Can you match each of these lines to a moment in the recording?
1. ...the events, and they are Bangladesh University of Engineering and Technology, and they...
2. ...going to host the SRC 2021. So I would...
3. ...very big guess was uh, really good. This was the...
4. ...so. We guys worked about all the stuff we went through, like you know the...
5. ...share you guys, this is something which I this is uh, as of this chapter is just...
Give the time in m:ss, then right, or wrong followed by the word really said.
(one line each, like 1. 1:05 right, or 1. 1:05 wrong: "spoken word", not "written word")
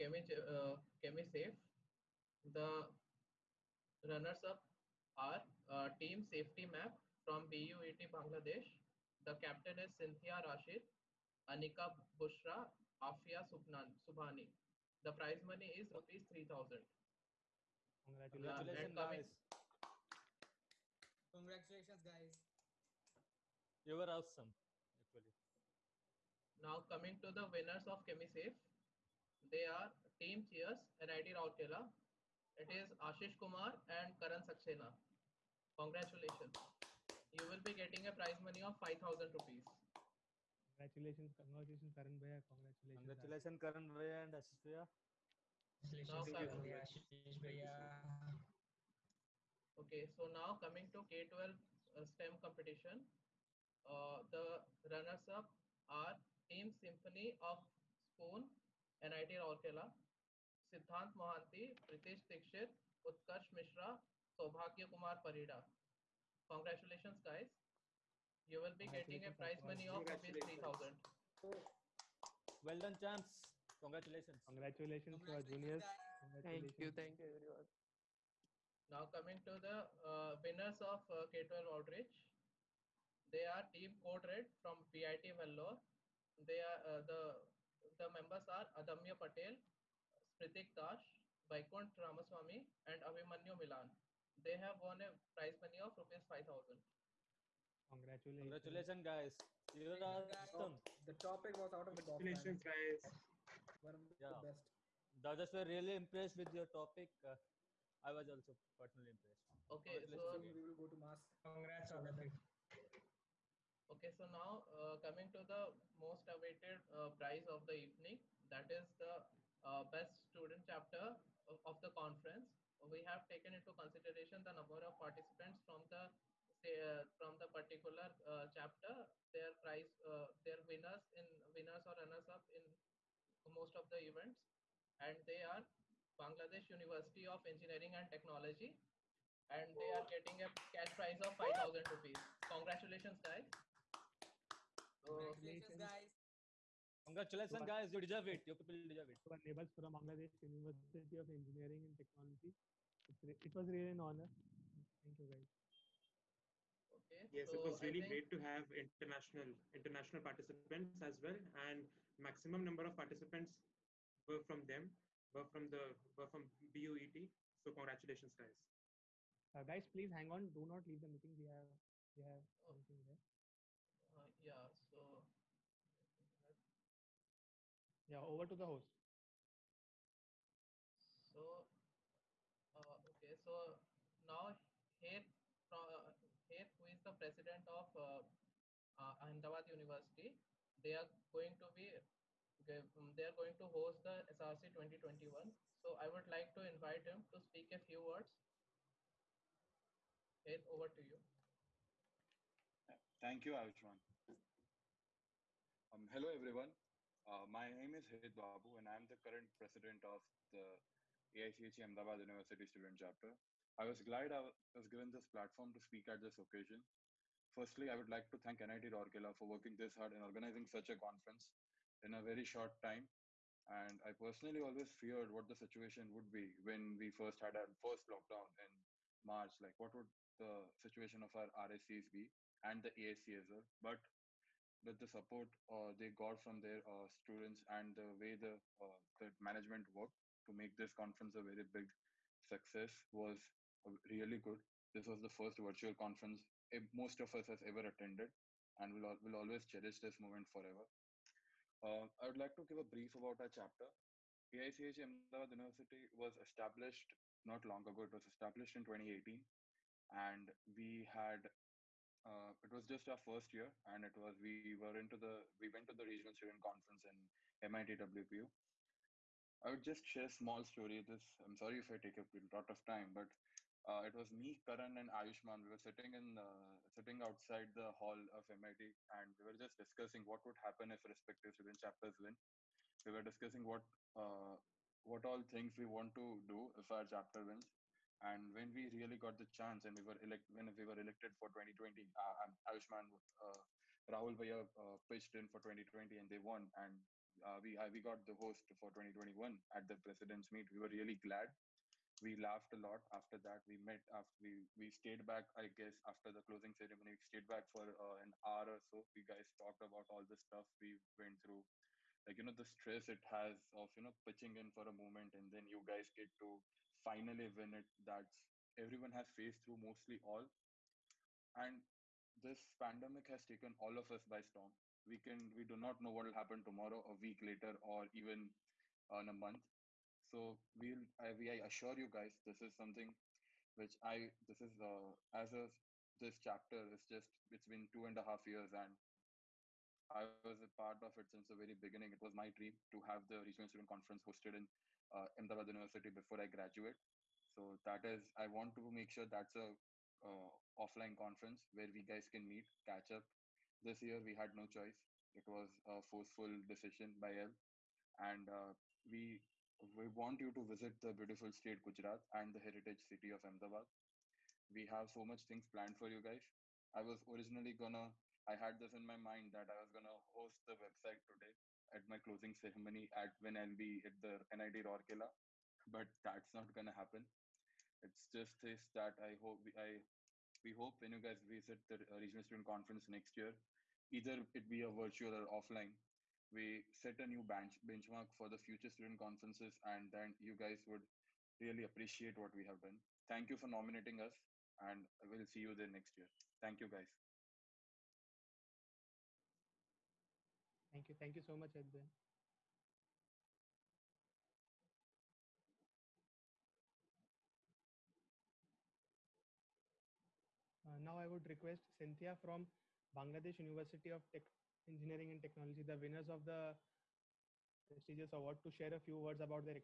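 1. 2:13 right
2. 3:13 right
3. 4:01 wrong: "success", not "guess"
4. 5:08 wrong: "talked", not "worked"
5. 5:31 wrong: "assure", not "share".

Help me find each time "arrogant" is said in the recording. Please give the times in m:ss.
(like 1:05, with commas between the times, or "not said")
not said.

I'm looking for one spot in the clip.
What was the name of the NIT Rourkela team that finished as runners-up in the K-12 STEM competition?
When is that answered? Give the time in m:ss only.
0:56.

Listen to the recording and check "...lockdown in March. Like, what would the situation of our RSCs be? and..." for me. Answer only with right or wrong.
right.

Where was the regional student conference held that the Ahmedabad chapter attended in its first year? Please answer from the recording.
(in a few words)
MIT WPU.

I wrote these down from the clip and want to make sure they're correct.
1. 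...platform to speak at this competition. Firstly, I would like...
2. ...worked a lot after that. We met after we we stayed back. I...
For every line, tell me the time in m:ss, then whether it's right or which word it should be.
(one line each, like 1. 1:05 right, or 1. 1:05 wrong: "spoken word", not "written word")
1. 3:35 wrong: "occasion", not "competition"
2. 5:02 wrong: "laughed", not "worked".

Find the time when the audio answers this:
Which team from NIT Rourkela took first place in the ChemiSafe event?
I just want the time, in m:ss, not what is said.
0:30.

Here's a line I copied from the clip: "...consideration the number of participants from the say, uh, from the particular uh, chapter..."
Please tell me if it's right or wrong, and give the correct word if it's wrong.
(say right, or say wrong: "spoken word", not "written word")
right.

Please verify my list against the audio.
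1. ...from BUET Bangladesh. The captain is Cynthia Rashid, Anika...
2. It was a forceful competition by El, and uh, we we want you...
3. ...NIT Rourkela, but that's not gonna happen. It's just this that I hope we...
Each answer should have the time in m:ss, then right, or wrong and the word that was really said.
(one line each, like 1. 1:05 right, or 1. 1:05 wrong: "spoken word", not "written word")
1. 0:07 right
2. 5:55 wrong: "decision", not "competition"
3. 6:14 right.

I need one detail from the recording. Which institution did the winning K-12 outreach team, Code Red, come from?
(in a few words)
VIT Vellore.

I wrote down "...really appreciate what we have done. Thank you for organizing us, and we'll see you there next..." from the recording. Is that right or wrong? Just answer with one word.
wrong.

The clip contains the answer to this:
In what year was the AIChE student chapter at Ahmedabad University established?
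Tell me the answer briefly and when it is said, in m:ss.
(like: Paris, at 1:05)
2018, at 4:18.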